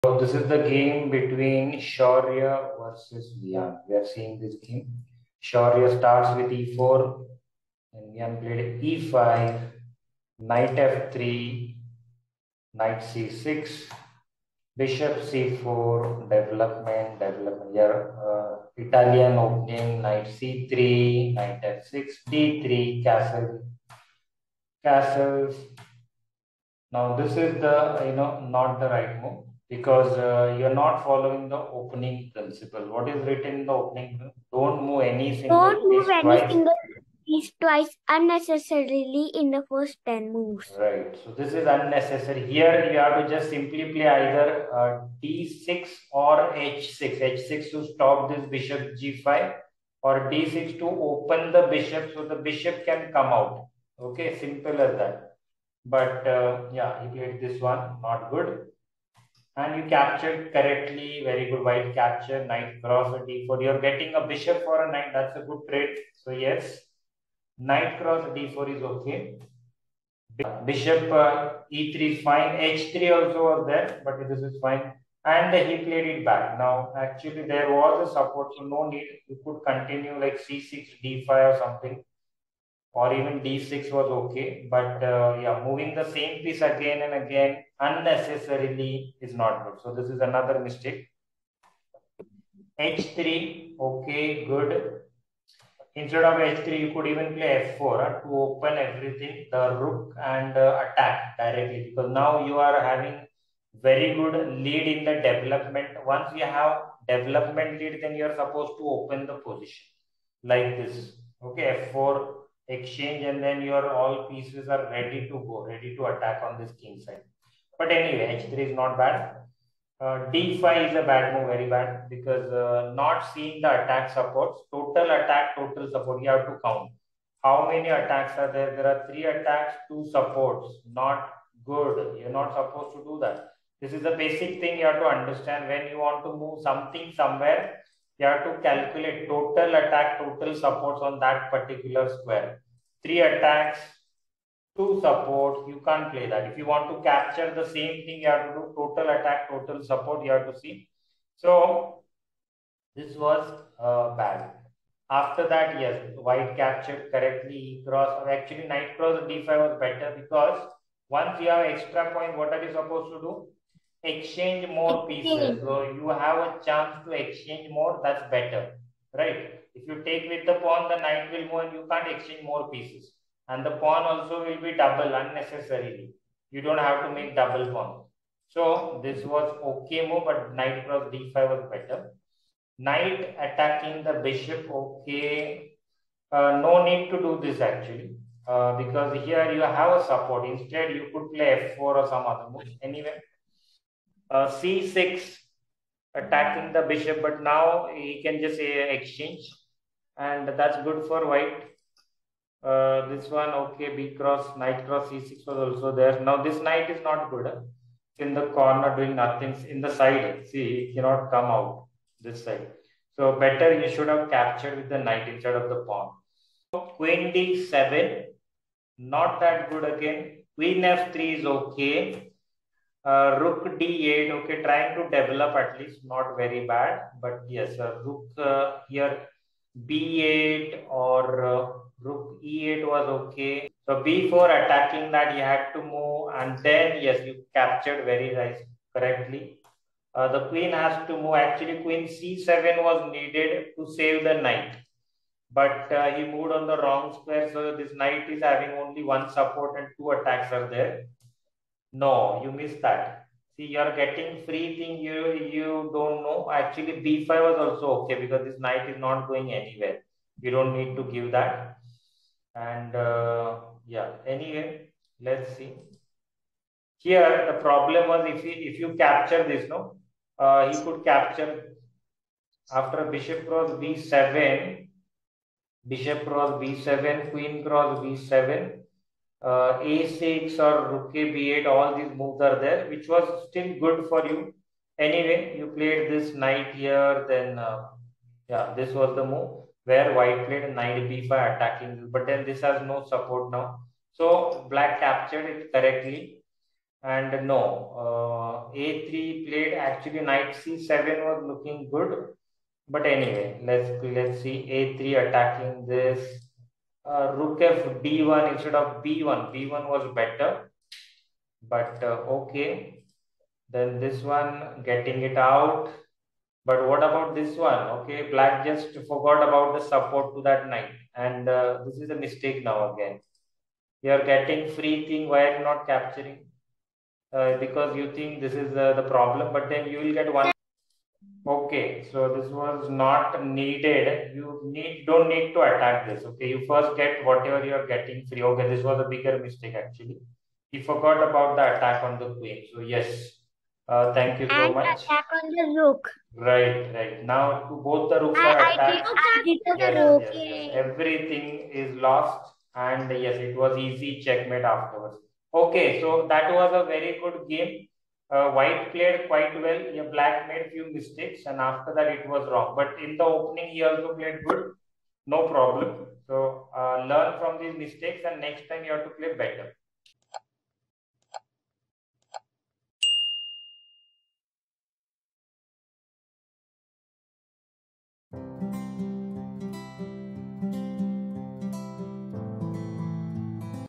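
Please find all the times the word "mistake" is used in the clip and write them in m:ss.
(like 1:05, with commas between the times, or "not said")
1:30, 5:22, 5:39, 6:00, 6:07.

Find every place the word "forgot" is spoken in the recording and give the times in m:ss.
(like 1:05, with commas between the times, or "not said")
5:19, 5:40.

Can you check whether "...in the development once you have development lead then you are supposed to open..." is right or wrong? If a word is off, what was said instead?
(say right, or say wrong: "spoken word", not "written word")
right.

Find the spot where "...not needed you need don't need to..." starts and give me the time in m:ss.
5:32.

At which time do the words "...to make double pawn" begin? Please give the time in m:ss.
2:57.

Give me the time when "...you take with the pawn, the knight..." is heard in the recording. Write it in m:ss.
2:49.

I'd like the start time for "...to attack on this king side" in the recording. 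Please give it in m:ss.
1:55.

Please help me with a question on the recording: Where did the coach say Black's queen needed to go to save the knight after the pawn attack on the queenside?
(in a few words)
c7.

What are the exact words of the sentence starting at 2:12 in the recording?
You're not supposed to do that.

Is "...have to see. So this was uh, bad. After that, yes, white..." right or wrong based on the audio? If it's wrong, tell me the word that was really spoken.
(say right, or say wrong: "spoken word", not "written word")
right.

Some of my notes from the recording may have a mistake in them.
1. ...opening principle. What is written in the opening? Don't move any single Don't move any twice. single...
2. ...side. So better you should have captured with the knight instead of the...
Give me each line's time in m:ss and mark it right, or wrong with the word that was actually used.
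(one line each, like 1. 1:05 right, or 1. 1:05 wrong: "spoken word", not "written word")
1. 0:31 right
2. 3:32 right.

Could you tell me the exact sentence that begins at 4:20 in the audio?
You don't need to give that.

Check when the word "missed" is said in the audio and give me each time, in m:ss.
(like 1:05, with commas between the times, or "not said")
4:12.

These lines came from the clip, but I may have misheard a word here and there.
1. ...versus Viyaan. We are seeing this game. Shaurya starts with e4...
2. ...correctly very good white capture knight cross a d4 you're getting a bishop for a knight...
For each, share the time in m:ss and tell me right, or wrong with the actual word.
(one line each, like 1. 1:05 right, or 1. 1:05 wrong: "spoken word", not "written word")
1. 0:02 right
2. 1:00 right.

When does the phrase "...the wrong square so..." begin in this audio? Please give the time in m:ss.
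4:06.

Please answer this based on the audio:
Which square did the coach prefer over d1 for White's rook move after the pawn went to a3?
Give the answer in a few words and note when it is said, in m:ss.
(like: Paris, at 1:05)
b1, at 5:09.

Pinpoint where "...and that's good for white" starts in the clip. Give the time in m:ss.
3:20.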